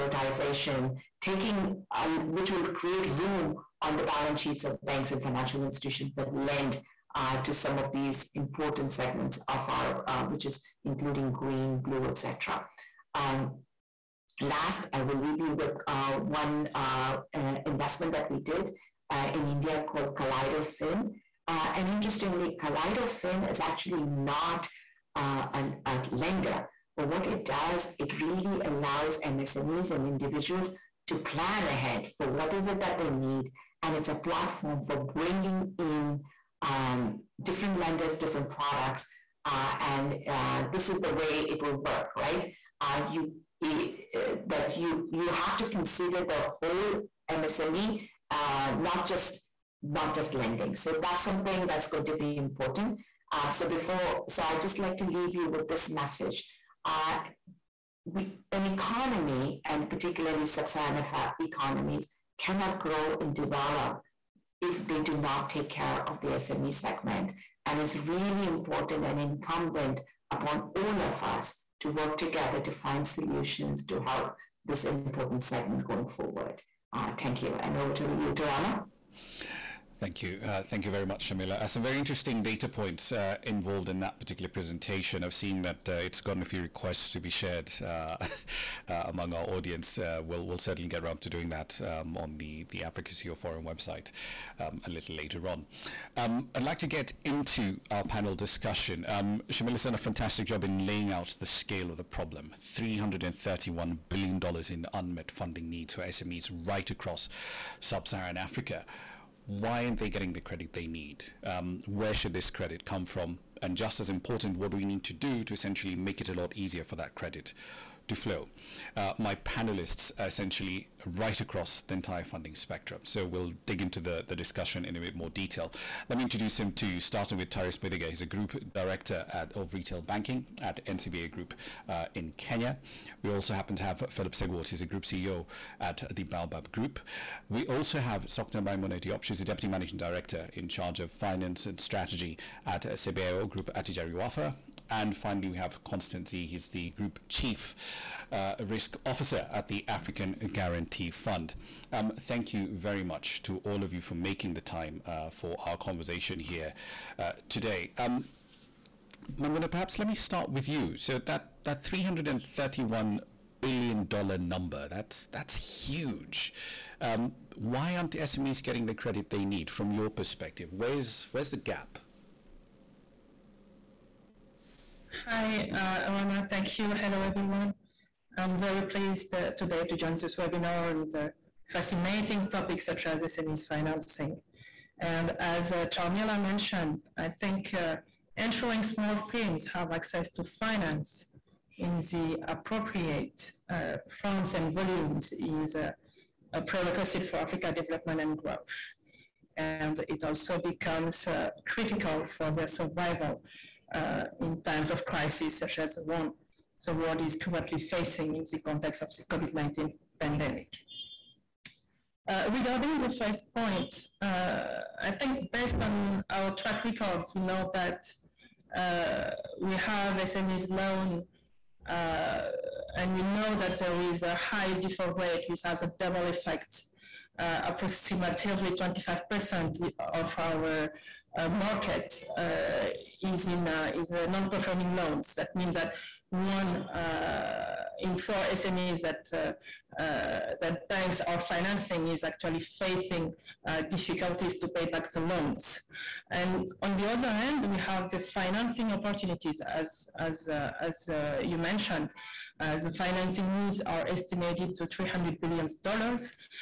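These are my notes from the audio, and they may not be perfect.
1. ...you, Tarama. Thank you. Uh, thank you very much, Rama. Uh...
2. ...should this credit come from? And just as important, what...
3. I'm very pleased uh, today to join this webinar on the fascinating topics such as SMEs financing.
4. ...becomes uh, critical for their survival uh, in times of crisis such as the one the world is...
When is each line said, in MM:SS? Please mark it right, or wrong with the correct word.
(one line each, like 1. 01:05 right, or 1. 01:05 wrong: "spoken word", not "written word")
1. 01:18 wrong: "Sharmila", not "Rama"
2. 01:52 right
3. 02:58 right
4. 03:20 right.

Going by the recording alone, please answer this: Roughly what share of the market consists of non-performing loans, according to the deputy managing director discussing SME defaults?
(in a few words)
25%.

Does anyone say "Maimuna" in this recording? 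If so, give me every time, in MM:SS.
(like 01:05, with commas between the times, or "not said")
02:18, 02:39.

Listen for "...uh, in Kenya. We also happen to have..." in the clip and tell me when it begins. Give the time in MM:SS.
02:11.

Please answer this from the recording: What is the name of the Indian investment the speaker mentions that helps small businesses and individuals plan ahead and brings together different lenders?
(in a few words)
Kaleidofin.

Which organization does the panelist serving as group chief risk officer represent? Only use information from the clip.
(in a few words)
African Guarantee Fund.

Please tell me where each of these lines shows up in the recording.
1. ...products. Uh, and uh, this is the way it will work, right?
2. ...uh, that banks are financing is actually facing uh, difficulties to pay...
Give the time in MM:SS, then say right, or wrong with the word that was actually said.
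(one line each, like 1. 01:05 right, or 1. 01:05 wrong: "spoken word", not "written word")
1. 00:38 right
2. 04:00 right.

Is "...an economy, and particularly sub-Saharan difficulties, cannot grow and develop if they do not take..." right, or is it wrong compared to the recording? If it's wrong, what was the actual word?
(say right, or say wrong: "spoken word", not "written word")
wrong: "economies", not "difficulties".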